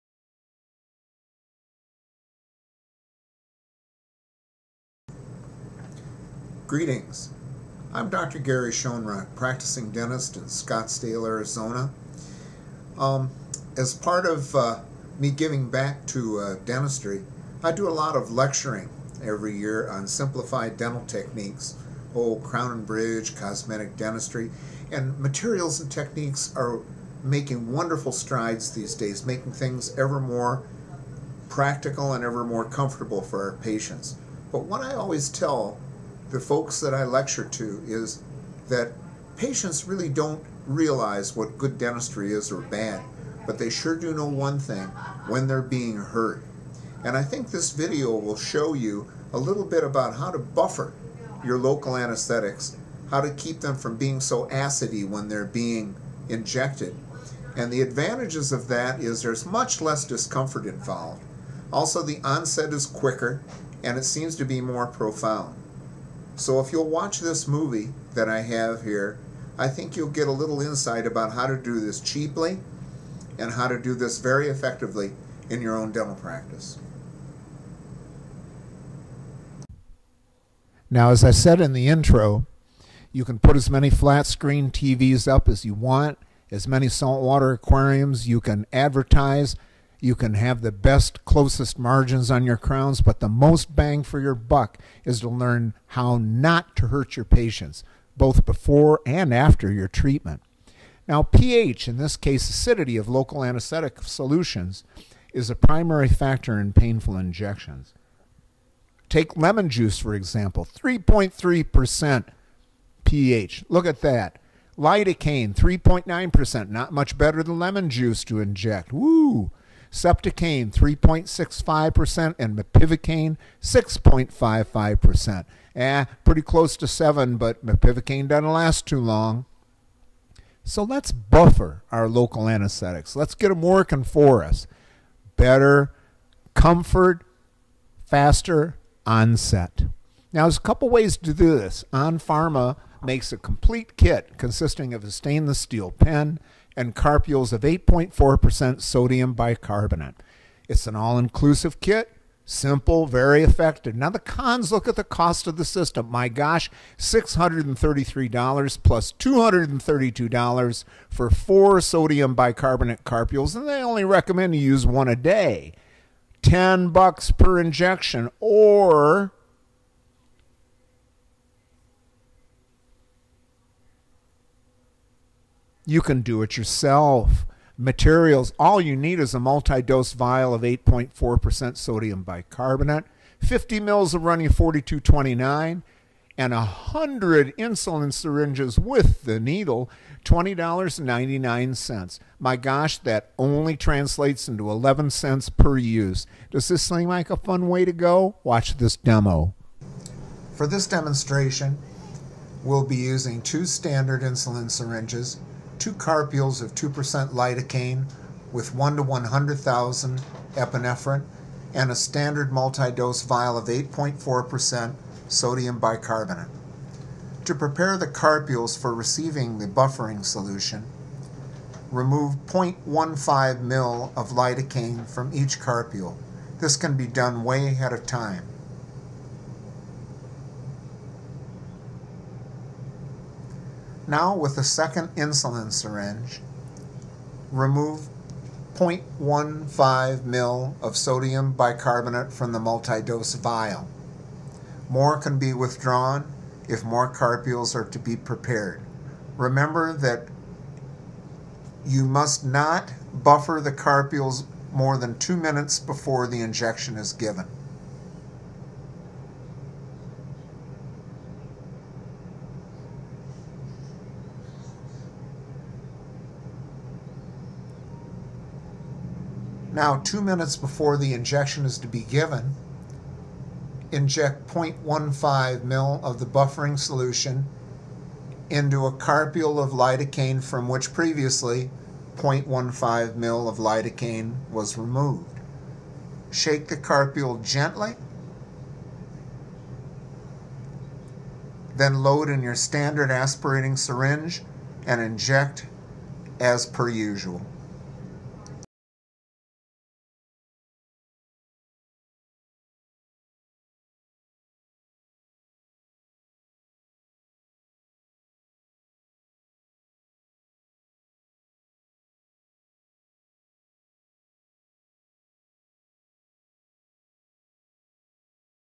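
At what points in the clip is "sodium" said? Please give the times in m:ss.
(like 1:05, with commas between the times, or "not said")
2:28, 2:41, 3:01, 3:35, 4:00.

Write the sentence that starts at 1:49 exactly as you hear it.
Take lemon juice, for example, 3.3% pH.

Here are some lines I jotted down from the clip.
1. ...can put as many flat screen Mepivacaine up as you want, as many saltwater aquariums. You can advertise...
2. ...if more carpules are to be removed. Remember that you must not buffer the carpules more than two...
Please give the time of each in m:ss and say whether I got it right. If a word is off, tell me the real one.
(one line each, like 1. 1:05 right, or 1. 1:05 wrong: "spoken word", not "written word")
1. 1:23 wrong: "TVs", not "Mepivacaine"
2. 4:06 wrong: "prepared", not "removed".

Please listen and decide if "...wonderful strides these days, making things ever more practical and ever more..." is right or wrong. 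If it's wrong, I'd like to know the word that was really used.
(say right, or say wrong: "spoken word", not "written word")
right.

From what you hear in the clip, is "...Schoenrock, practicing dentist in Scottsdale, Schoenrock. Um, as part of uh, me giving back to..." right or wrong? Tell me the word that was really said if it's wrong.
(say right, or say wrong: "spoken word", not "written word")
wrong: "Arizona", not "Schoenrock".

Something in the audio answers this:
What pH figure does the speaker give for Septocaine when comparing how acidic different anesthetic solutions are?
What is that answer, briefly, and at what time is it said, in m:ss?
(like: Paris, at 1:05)
3.65, at 2:00.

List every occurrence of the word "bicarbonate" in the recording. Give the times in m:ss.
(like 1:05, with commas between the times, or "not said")
2:29, 2:42, 3:02, 3:35, 4:01.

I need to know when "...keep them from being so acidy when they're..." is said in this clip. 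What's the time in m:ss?
0:53.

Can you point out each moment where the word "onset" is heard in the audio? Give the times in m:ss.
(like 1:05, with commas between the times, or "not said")
1:02, 2:19.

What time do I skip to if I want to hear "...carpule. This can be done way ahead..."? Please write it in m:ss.
3:45.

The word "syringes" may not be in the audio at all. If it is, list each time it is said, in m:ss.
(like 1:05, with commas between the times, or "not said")
3:08, 3:24, 3:55, 4:53.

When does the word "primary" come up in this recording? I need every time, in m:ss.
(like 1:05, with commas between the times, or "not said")
1:45.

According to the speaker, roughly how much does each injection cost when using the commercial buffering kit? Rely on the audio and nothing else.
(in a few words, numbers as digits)
$10.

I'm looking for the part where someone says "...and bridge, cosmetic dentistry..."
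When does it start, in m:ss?
0:22.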